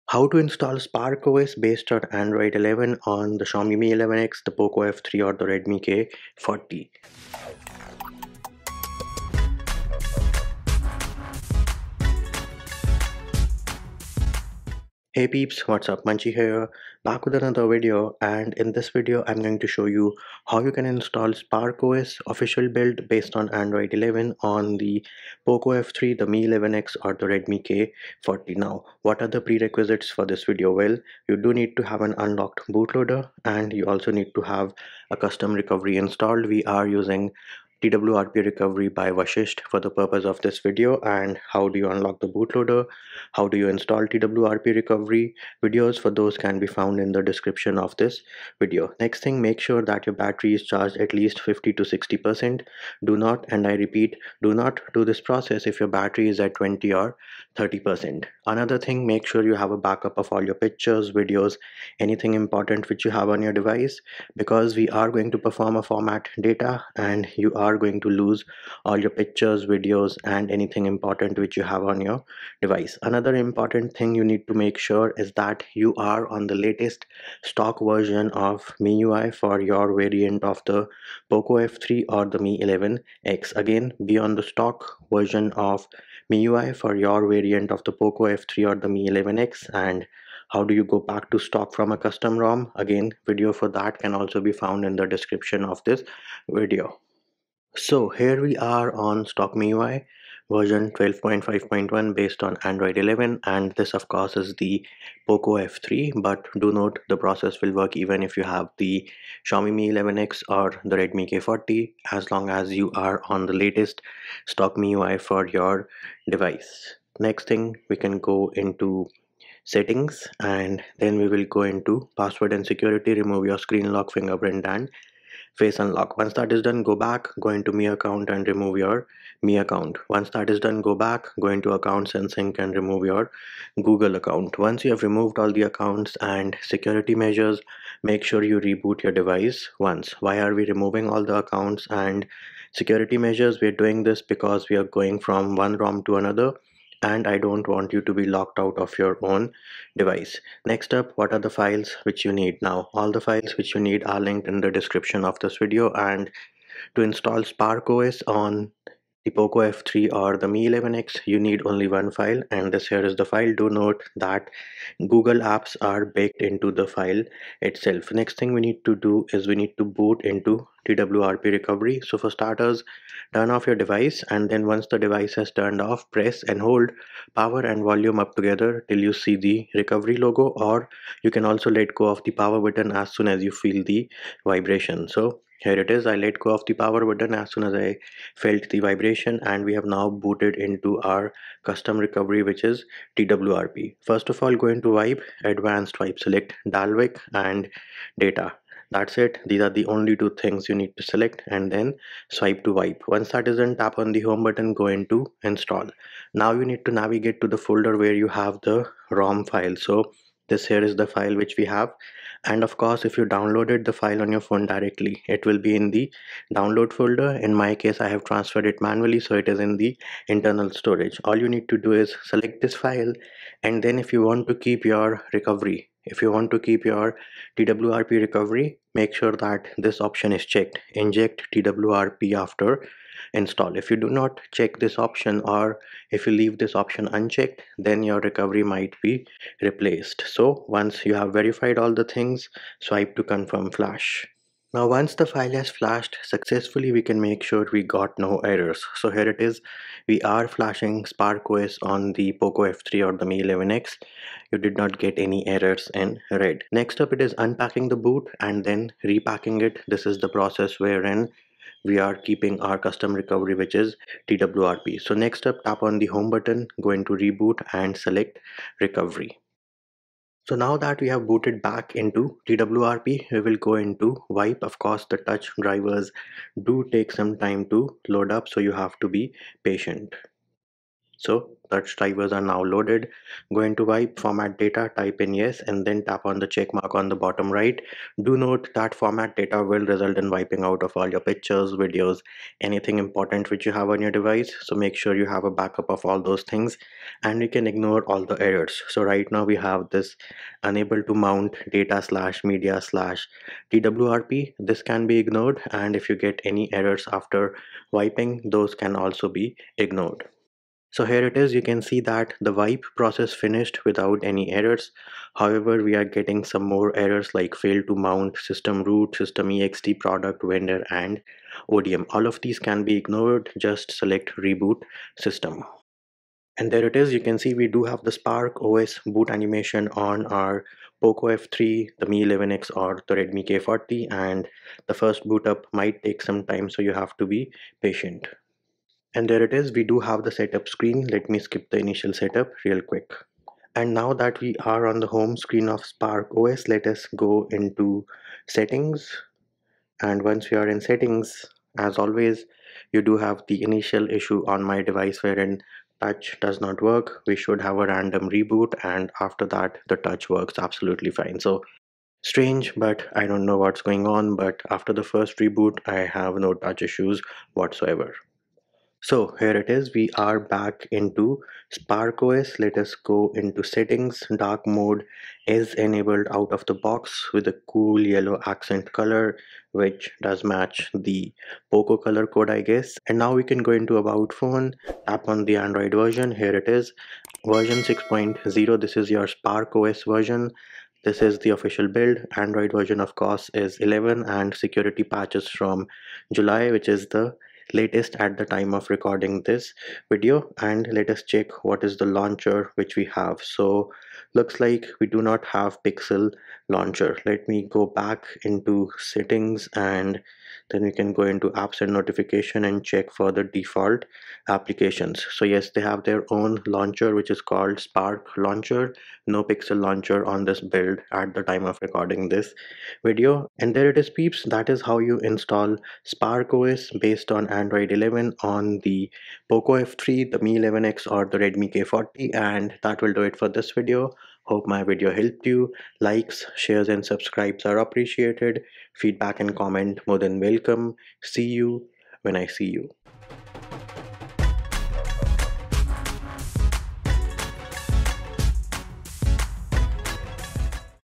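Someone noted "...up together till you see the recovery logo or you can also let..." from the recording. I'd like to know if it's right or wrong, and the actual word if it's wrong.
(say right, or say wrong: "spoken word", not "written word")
right.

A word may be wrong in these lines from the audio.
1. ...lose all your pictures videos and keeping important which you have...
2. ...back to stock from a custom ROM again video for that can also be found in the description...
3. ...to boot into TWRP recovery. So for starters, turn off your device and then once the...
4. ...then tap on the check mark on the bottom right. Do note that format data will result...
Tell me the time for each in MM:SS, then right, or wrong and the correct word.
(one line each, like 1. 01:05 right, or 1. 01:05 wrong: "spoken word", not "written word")
1. 01:08 wrong: "anything", not "keeping"
2. 01:31 right
3. 02:49 right
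4. 04:45 right.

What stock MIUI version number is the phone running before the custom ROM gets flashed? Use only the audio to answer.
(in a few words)
12.5.1.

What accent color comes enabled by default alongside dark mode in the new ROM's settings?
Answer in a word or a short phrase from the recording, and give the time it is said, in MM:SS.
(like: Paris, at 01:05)
yellow, at 06:18.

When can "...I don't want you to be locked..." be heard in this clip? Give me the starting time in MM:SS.
02:27.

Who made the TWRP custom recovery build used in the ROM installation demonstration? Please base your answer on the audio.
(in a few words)
Vashisht.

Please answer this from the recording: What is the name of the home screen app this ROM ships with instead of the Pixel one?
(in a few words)
Spark Launcher.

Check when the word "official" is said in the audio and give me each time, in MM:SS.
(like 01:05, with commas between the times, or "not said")
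00:22, 06:31.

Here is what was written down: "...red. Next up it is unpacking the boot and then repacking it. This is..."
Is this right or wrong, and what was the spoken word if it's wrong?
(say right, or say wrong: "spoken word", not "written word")
right.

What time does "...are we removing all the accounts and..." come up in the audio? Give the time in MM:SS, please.
02:20.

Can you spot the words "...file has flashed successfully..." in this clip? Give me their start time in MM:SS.
04:05.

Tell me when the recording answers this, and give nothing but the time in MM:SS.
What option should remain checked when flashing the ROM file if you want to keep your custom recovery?
03:51.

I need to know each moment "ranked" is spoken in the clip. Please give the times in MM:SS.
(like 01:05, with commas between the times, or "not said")
not said.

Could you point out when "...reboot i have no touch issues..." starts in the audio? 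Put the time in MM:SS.
06:05.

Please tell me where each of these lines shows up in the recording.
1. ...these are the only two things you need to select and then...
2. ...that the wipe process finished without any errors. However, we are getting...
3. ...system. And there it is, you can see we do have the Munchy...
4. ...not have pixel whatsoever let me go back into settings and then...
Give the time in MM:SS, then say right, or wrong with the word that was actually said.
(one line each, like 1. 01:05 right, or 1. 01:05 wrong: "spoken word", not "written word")
1. 03:19 right
2. 05:12 right
3. 05:25 wrong: "Spark", not "Munchy"
4. 06:45 wrong: "launcher", not "whatsoever".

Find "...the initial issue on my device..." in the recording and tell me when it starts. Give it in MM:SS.
05:53.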